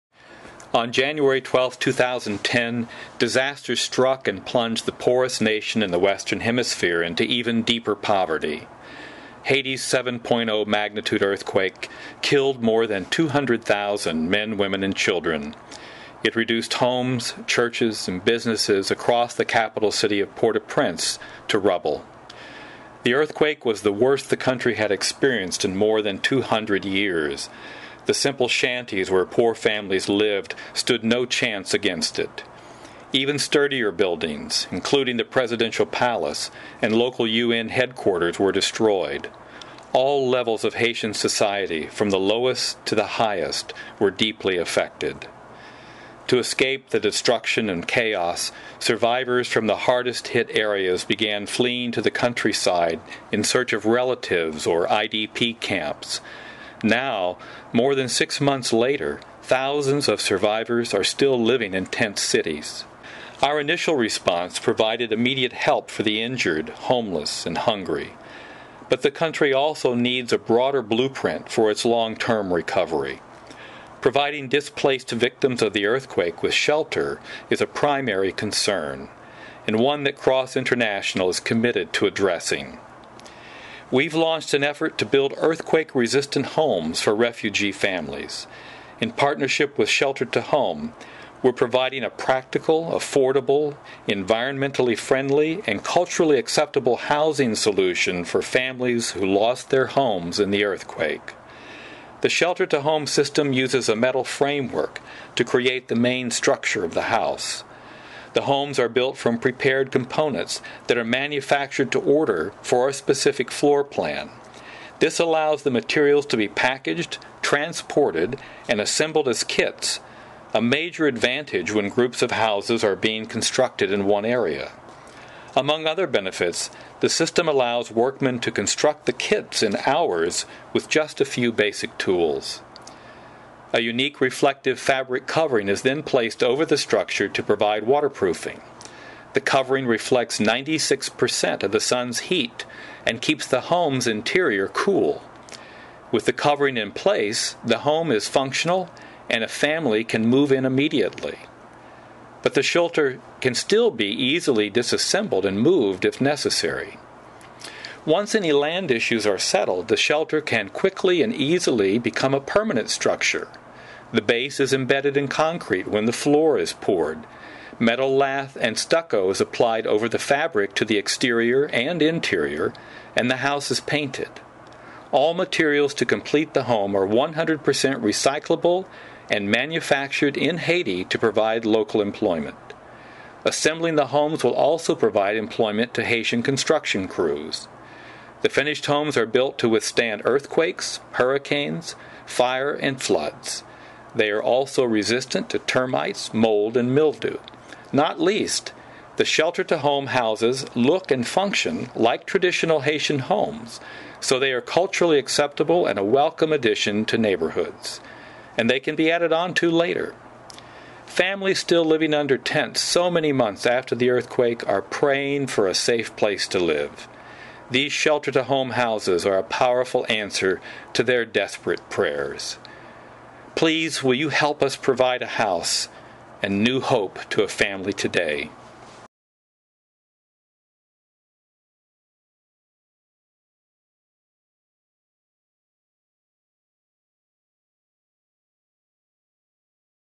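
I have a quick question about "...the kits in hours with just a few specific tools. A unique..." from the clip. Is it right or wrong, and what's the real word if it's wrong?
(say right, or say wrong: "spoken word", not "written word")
wrong: "basic", not "specific".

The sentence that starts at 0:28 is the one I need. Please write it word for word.
The simple shanties where poor families lived stood no chance against it.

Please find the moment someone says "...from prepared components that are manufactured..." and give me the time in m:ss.
1:49.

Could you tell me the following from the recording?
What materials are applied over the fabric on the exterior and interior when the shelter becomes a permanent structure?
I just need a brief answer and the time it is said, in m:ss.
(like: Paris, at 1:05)
Metal lath and stucco, at 2:47.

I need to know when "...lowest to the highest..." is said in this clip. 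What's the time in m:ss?
0:42.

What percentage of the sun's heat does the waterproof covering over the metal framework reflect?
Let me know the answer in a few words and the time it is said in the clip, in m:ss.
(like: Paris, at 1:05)
96%, at 2:20.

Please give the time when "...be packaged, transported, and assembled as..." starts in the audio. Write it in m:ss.
1:56.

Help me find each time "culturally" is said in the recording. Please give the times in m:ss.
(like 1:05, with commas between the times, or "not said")
1:35, 3:24.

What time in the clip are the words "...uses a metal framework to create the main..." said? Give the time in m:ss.
1:43.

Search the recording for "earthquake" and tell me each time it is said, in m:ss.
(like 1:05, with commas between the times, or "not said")
0:11, 0:23, 1:15, 1:25, 1:40, 3:10, 3:34.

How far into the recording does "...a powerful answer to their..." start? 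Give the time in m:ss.
3:39.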